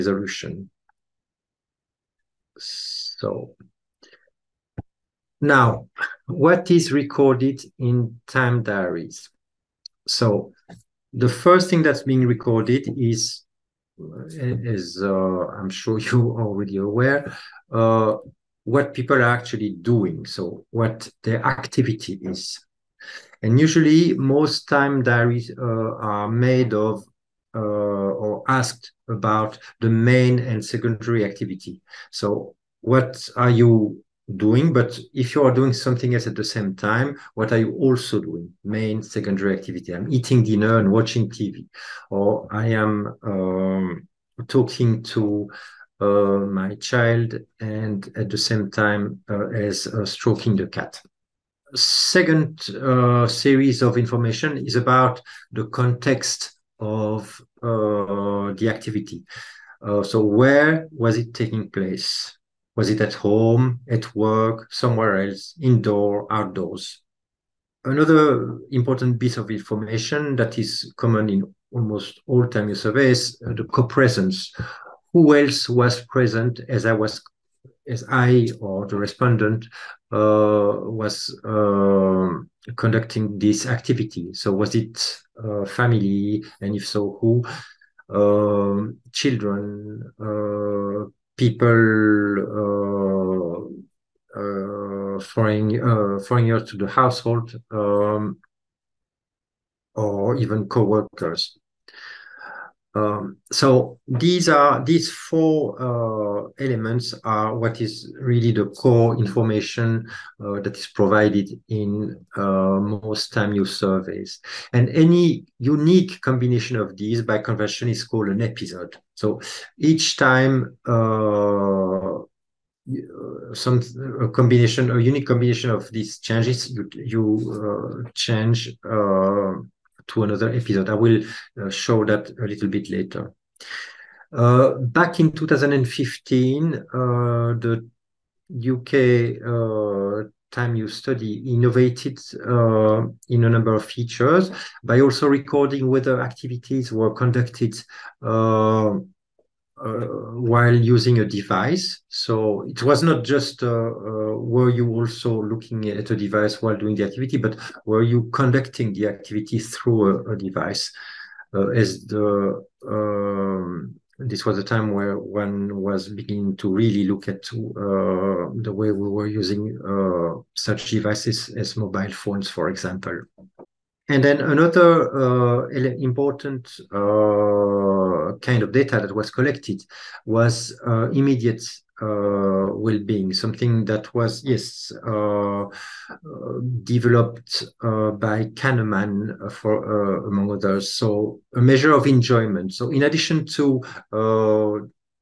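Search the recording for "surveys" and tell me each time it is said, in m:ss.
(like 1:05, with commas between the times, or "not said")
1:12, 1:53.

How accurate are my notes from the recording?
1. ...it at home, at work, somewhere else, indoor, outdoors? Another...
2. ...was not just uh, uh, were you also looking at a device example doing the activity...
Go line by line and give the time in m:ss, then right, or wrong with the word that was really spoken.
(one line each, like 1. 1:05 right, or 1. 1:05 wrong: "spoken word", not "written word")
1. 1:02 right
2. 2:32 wrong: "while", not "example".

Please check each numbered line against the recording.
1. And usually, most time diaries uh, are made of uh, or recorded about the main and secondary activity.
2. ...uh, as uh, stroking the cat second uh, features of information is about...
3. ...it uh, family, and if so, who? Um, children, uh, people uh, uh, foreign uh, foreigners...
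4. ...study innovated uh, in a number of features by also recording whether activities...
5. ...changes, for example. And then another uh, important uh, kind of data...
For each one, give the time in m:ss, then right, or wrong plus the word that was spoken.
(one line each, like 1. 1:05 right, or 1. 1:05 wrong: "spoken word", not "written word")
1. 0:23 wrong: "asked", not "recorded"
2. 0:49 wrong: "series", not "features"
3. 1:24 right
4. 2:20 right
5. 2:52 wrong: "phones", not "changes".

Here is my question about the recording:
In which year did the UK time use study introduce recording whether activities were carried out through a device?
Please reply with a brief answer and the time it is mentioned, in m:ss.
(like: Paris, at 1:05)
2015, at 2:15.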